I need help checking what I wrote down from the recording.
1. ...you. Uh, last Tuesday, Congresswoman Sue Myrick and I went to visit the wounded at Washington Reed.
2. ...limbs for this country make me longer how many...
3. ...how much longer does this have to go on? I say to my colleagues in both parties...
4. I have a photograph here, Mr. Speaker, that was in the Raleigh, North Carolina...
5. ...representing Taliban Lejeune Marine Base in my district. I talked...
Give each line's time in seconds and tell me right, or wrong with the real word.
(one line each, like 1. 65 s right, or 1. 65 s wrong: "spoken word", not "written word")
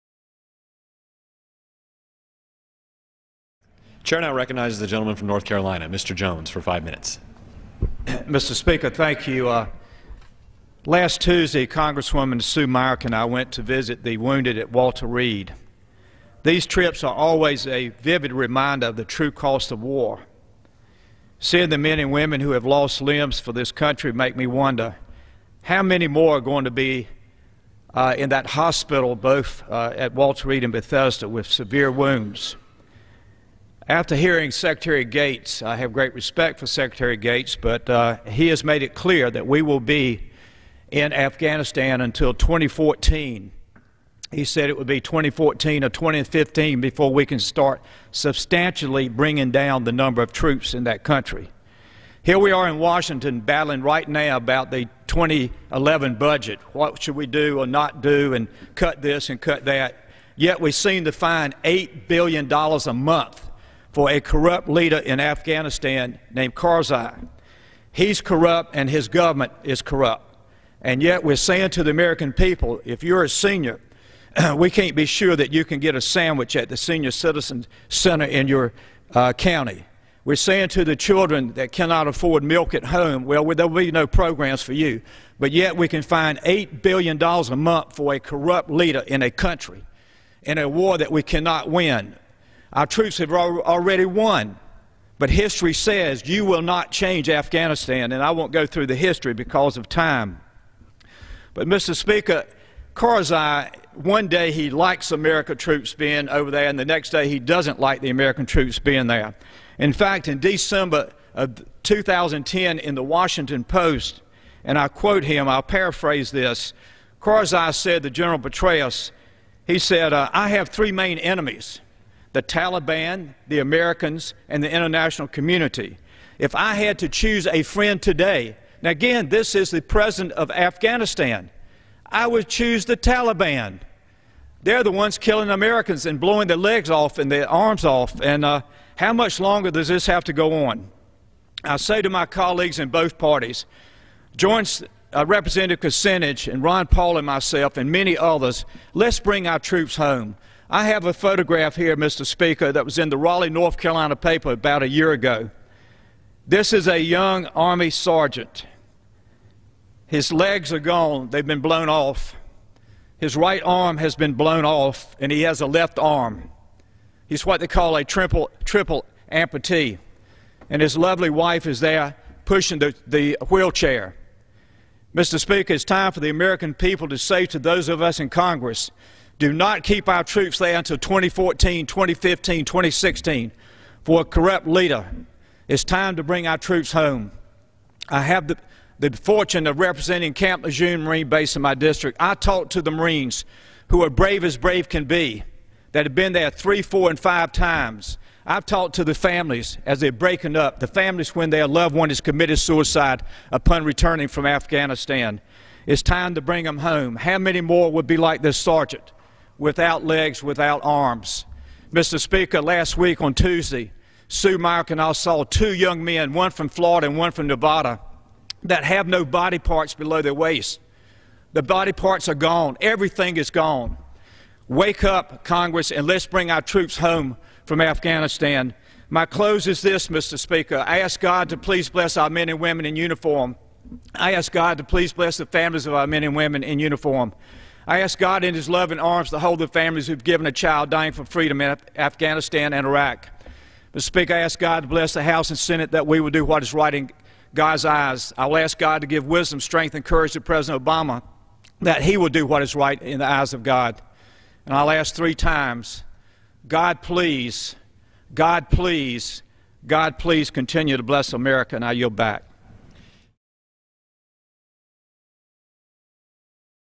1. 9 s wrong: "Walter", not "Washington"
2. 23 s wrong: "wonder", not "longer"
3. 138 s right
4. 150 s right
5. 189 s wrong: "Camp", not "Taliban".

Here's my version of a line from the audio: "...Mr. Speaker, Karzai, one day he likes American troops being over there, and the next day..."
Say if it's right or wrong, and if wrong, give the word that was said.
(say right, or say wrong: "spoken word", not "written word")
right.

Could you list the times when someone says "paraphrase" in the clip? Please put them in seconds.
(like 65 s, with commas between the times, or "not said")
115 s.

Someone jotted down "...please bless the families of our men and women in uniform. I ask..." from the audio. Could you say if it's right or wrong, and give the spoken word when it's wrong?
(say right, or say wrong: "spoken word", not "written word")
right.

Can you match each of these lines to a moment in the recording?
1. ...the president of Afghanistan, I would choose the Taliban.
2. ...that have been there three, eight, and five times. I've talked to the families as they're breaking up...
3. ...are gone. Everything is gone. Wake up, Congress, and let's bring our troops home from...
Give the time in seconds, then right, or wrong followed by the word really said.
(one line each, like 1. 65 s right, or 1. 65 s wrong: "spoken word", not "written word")
1. 129 s right
2. 195 s wrong: "four", not "eight"
3. 222 s right.